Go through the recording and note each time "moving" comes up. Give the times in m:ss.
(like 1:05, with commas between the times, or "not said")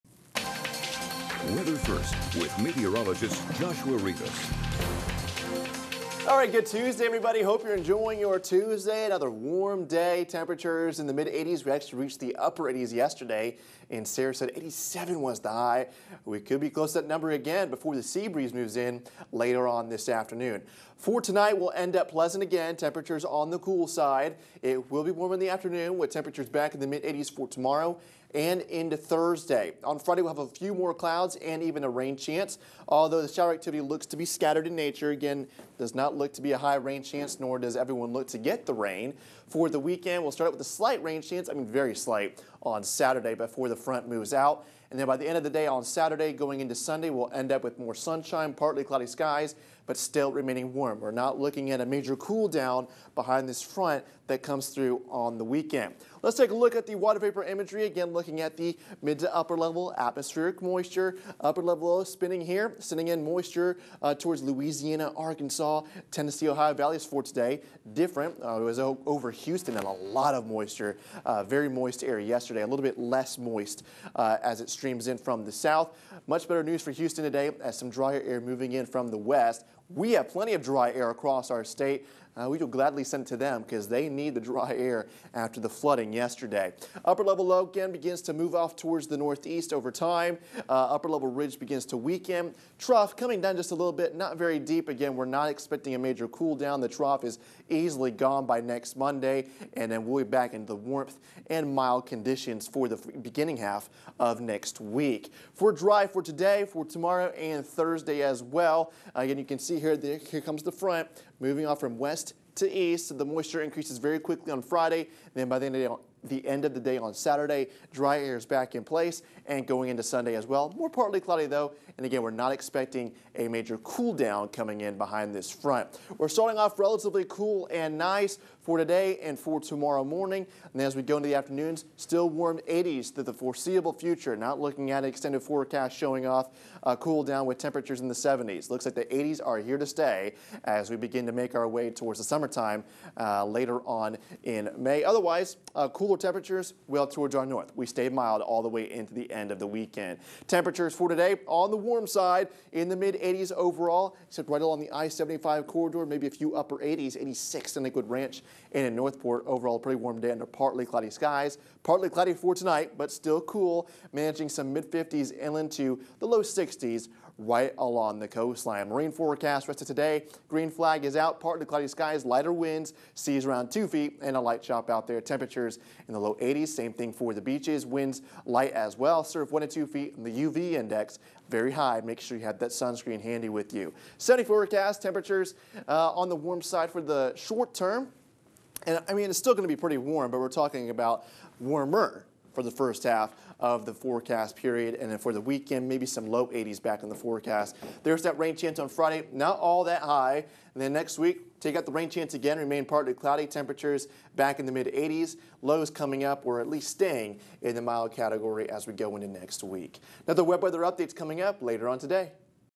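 1:18, 1:51.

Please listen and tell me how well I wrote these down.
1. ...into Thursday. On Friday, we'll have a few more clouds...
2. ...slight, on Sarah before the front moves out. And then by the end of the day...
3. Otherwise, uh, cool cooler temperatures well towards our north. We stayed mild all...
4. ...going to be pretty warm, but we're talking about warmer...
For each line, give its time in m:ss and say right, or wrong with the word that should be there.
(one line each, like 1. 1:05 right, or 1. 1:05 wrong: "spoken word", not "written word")
1. 0:28 right
2. 0:41 wrong: "Saturday", not "Sarah"
3. 2:25 right
4. 3:09 right.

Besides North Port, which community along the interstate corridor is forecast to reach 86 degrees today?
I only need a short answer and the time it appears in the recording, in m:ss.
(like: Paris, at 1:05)
Lakewood Ranch, at 2:37.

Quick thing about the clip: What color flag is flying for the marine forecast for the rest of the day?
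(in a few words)
Green.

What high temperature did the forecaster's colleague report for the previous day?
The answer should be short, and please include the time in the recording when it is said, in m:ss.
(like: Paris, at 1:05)
87, at 0:14.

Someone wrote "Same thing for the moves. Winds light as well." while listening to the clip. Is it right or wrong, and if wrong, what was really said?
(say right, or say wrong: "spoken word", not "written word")
wrong: "beaches", not "moves".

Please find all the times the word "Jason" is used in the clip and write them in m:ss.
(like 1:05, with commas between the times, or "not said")
not said.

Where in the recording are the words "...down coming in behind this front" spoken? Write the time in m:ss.
2:04.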